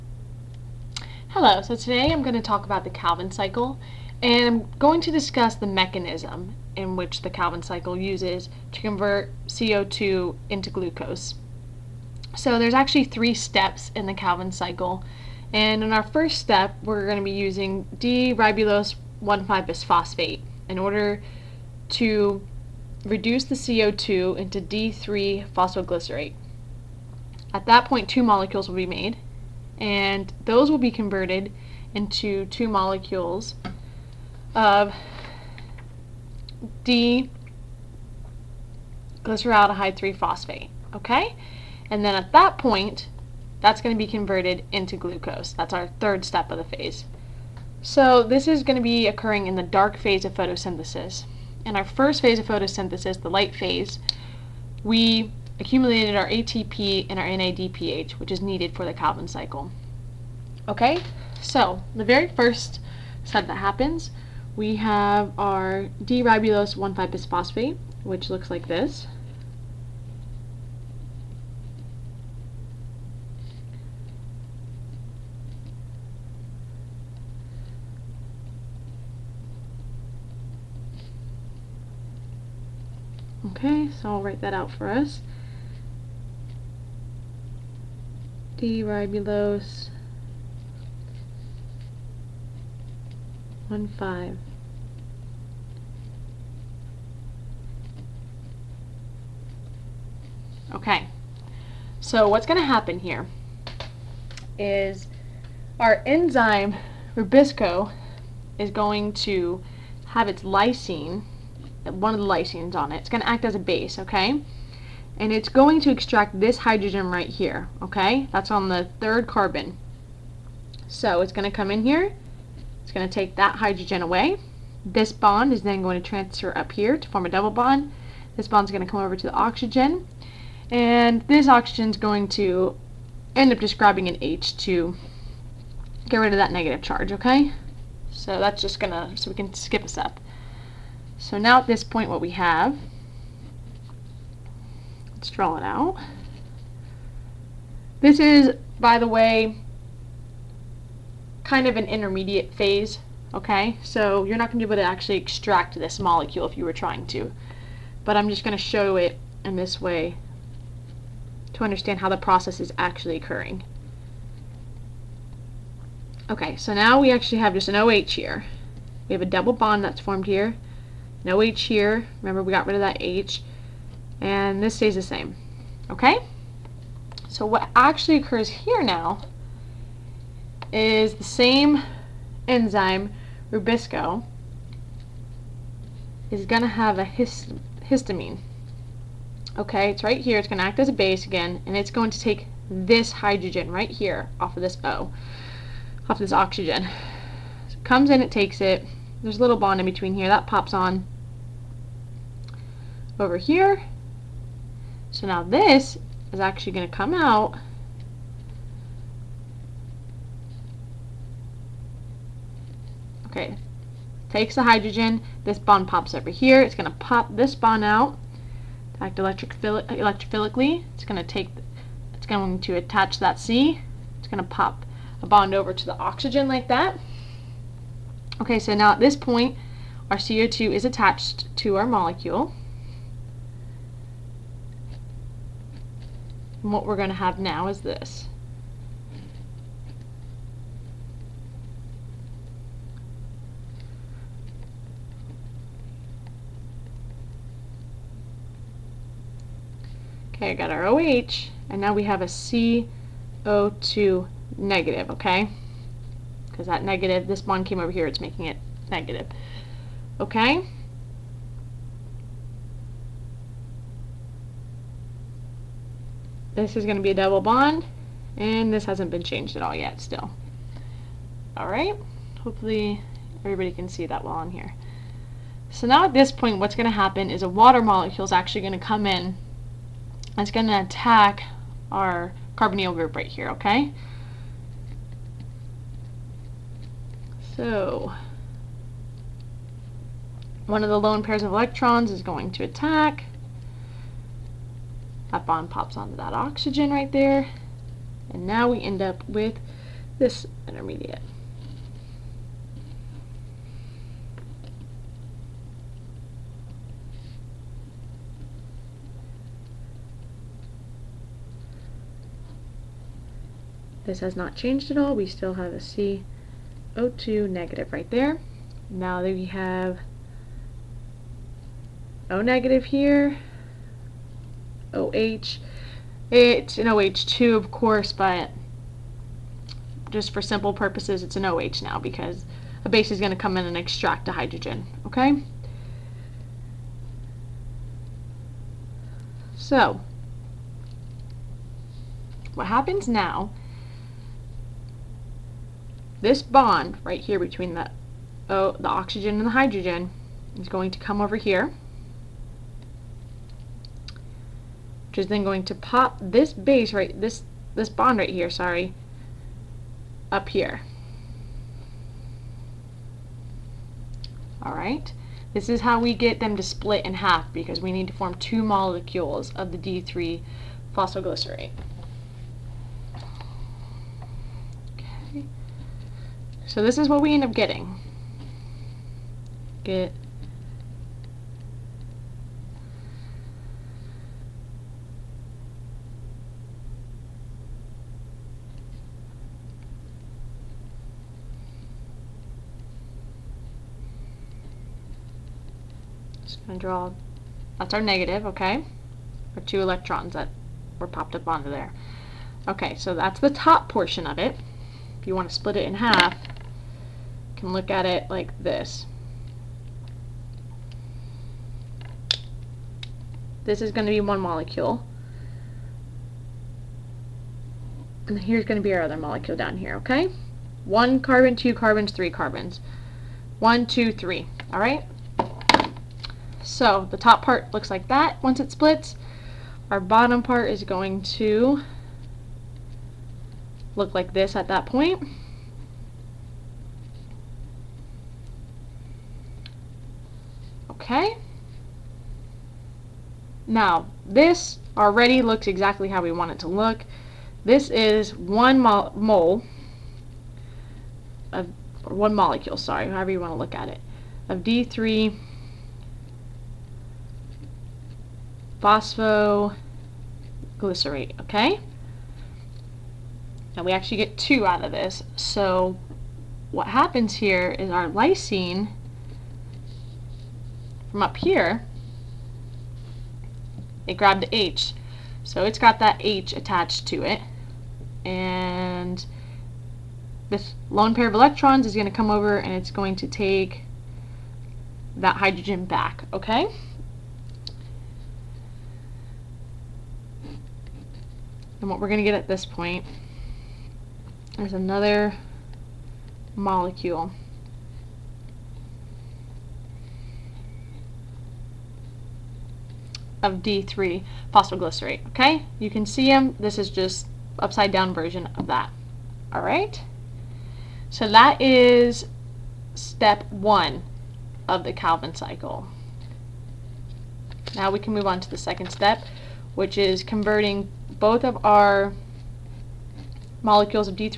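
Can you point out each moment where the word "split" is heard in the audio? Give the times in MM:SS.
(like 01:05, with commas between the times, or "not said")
06:06, 06:45, 07:08.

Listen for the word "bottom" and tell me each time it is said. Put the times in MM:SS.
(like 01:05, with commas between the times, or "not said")
07:09.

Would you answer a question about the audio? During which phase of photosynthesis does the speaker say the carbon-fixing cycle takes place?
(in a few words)
Dark phase.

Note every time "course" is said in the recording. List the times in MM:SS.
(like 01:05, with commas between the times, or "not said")
05:27.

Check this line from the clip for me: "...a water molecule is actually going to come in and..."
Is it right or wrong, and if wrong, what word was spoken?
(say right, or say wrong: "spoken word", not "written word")
right.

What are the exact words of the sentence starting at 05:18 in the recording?
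Now that we have O negative here, OH.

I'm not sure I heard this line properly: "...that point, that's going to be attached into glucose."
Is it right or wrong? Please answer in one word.
wrong.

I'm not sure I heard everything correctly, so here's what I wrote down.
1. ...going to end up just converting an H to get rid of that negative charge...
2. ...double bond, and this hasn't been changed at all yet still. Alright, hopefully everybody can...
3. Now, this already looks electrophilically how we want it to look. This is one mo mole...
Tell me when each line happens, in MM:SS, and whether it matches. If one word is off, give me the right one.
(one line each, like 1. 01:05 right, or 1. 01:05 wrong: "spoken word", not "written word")
1. 02:11 wrong: "grabbing", not "converting"
2. 04:27 right
3. 07:23 wrong: "exactly", not "electrophilically".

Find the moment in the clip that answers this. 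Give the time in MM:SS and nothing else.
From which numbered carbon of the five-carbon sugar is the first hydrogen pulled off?
01:58.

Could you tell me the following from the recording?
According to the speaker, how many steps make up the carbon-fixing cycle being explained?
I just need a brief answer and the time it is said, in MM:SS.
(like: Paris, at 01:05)
3, at 00:13.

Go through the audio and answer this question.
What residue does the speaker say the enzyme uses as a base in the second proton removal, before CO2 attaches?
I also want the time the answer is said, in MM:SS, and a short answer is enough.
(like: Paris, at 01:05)
Histamine, at 03:07.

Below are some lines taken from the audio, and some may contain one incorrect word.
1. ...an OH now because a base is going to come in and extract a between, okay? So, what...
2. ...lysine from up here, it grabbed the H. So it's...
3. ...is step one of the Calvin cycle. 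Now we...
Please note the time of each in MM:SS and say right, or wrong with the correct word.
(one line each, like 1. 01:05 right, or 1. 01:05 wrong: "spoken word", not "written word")
1. 05:31 wrong: "hydrogen", not "between"
2. 07:48 right
3. 08:31 right.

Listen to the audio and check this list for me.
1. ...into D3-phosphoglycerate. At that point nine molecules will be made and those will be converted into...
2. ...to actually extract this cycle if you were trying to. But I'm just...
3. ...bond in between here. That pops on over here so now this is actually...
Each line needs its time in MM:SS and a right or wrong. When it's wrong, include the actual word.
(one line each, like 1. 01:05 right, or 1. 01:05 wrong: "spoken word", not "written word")
1. 00:24 wrong: "two", not "nine"
2. 02:34 wrong: "molecule", not "cycle"
3. 03:19 right.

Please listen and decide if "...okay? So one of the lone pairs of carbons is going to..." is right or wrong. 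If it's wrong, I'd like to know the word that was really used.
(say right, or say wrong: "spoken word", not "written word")
wrong: "electrons", not "carbons".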